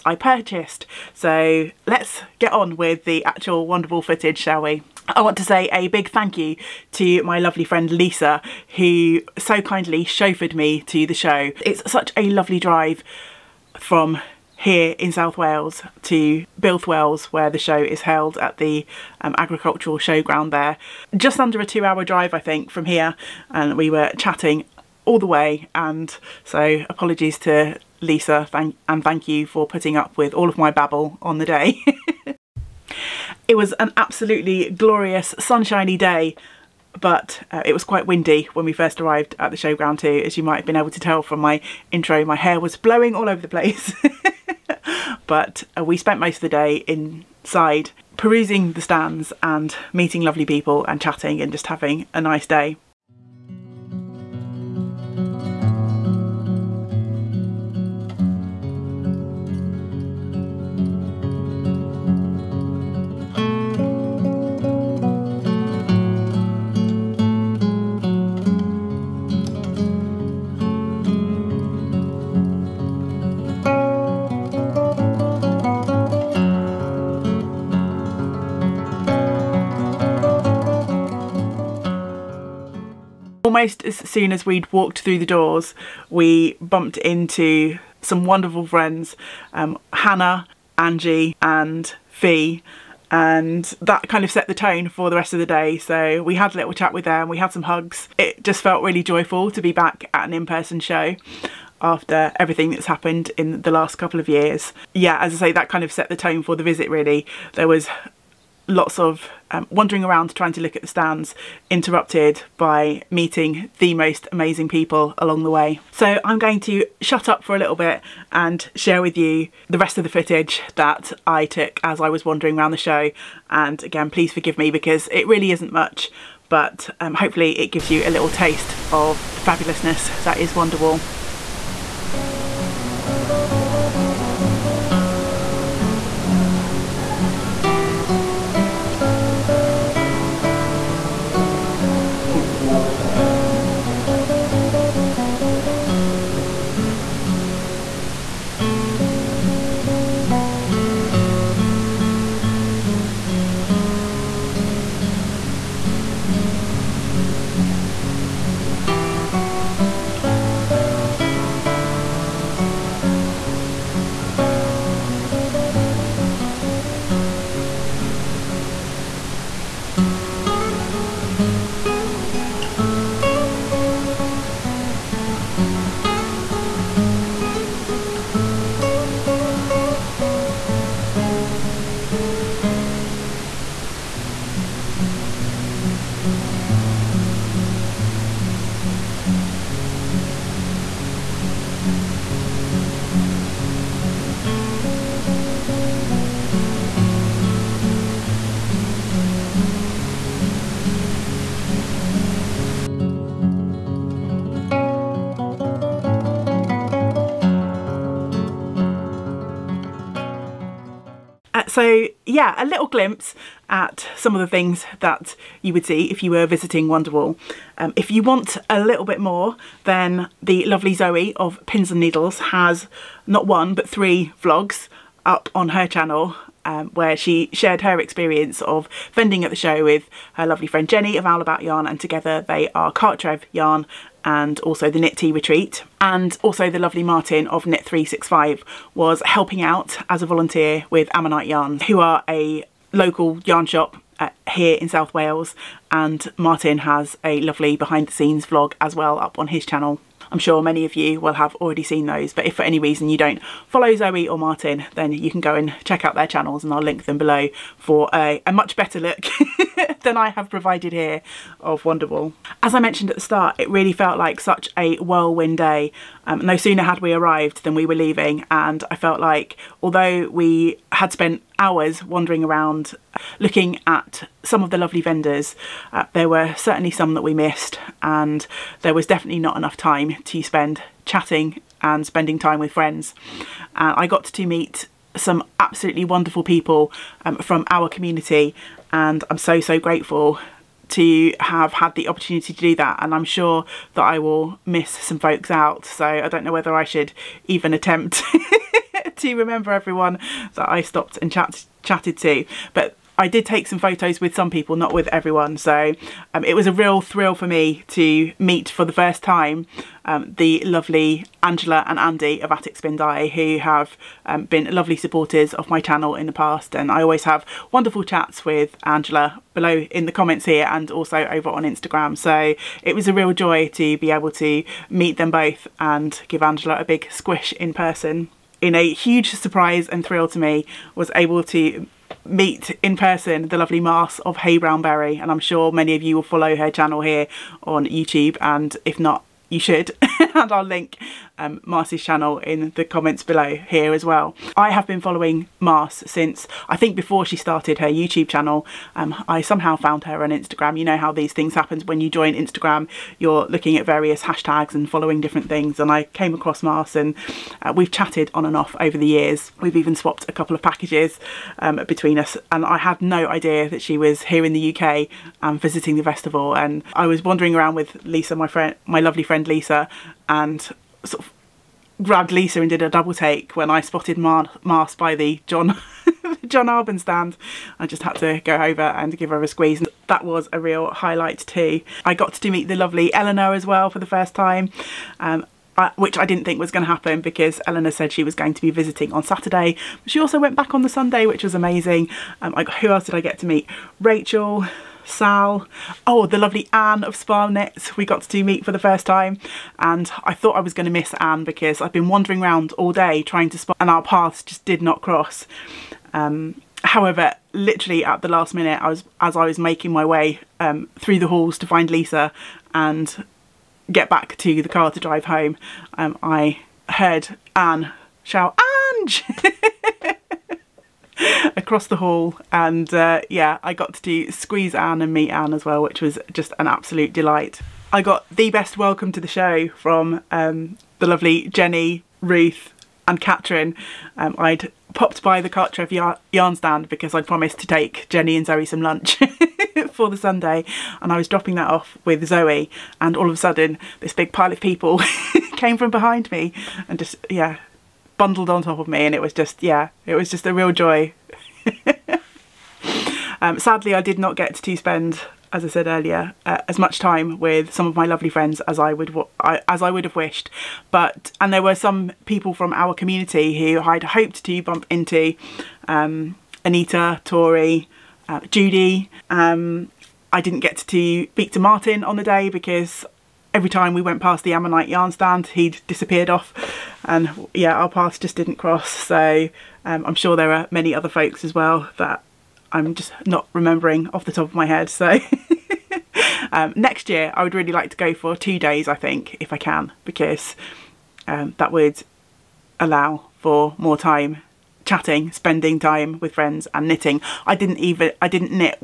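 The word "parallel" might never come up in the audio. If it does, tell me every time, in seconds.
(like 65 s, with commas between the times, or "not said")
not said.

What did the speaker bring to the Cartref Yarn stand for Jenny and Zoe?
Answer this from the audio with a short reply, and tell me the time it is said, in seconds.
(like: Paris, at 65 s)
Lunch, at 438 s.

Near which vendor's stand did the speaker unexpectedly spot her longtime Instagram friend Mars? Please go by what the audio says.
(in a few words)
John Arbon.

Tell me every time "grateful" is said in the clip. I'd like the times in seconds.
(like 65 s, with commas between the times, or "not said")
289 s.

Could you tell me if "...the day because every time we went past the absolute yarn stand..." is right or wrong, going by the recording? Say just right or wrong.
wrong.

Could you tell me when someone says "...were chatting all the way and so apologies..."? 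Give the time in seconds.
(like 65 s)
23 s.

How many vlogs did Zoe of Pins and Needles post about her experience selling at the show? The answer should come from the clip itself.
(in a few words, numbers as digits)
3.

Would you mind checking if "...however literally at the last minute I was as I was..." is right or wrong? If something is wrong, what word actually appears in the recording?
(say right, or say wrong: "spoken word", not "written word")
right.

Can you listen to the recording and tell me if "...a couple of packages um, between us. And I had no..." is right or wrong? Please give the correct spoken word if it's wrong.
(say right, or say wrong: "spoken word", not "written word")
right.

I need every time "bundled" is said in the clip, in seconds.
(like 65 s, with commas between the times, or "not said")
448 s.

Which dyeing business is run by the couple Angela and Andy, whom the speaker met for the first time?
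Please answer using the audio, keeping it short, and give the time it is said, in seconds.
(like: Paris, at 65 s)
Attic Spin Dye, at 312 s.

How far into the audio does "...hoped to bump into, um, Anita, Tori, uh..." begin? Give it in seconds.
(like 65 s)
464 s.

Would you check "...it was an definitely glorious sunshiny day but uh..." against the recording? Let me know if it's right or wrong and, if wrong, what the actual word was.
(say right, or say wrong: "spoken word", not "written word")
wrong: "absolutely", not "definitely".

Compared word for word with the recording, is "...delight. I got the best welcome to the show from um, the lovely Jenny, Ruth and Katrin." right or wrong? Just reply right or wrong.
right.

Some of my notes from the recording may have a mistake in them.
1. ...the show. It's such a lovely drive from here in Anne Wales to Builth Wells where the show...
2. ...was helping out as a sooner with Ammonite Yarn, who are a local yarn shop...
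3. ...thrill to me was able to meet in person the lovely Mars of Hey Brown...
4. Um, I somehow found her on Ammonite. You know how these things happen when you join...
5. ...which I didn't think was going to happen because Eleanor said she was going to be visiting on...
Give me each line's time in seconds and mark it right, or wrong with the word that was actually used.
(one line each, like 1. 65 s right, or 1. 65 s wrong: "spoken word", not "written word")
1. 11 s wrong: "South", not "Anne"
2. 238 s wrong: "volunteer", not "sooner"
3. 330 s right
4. 348 s wrong: "Instagram", not "Ammonite"
5. 385 s right.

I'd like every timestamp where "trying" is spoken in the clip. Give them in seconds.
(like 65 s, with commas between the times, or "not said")
110 s, 403 s.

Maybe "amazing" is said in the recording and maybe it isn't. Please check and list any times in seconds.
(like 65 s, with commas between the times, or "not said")
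114 s, 391 s.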